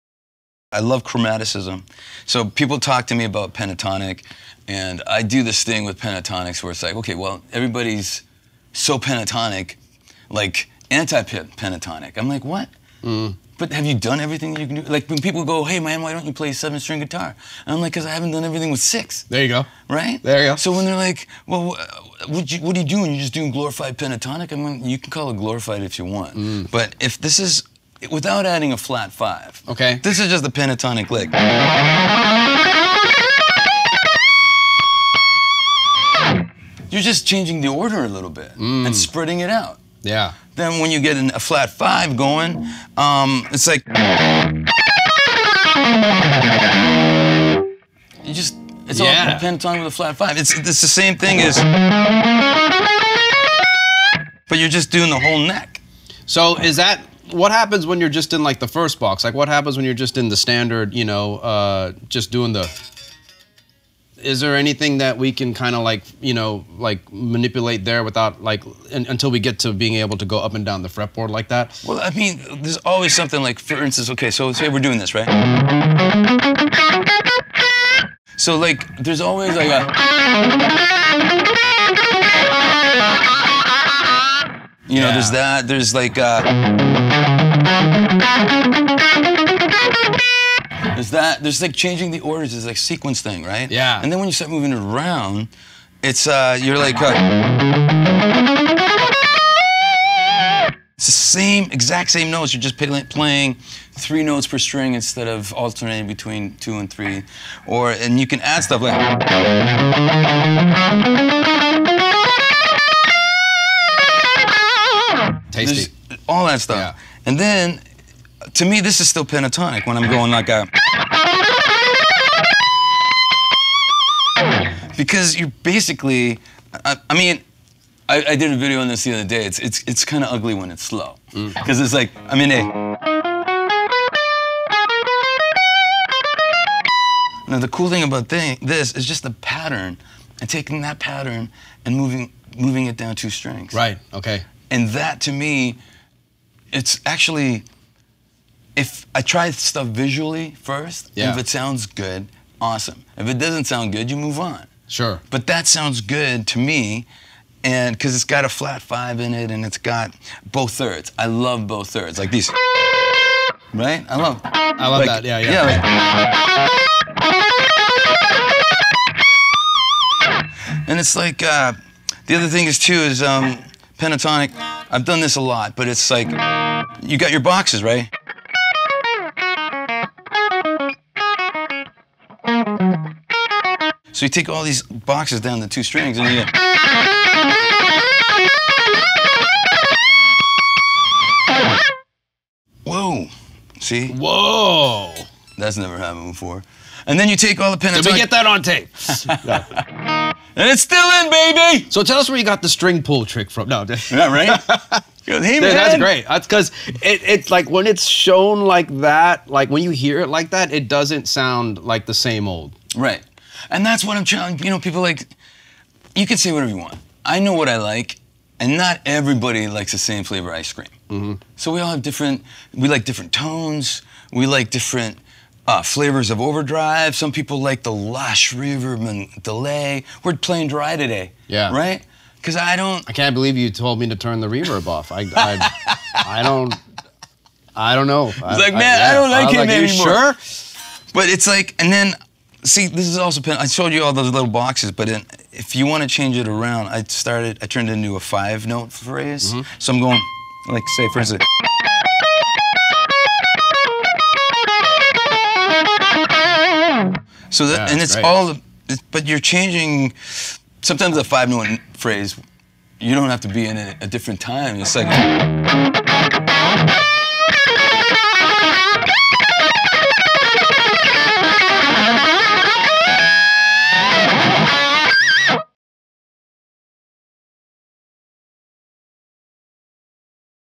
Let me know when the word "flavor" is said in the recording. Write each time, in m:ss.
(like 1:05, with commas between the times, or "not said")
3:40, 3:45.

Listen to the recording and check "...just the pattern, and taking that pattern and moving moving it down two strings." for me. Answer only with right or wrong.
right.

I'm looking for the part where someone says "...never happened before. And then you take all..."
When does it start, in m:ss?
3:15.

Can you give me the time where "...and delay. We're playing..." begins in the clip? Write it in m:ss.
3:49.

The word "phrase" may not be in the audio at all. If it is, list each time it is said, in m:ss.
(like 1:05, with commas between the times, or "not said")
4:08, 4:21.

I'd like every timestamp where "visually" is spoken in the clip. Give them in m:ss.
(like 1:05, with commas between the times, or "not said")
2:29.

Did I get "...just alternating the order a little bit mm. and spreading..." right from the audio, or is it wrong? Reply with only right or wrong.
wrong.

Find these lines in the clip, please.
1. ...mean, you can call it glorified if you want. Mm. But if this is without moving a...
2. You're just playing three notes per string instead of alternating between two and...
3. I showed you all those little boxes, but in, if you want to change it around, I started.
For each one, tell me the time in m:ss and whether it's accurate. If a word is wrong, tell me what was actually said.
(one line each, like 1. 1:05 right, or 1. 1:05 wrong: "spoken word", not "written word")
1. 0:24 wrong: "adding", not "moving"
2. 1:42 right
3. 4:03 right.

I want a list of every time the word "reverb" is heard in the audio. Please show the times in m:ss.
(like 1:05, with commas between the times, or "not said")
3:48, 3:54.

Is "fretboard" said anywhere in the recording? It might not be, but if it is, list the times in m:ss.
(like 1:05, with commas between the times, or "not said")
1:10.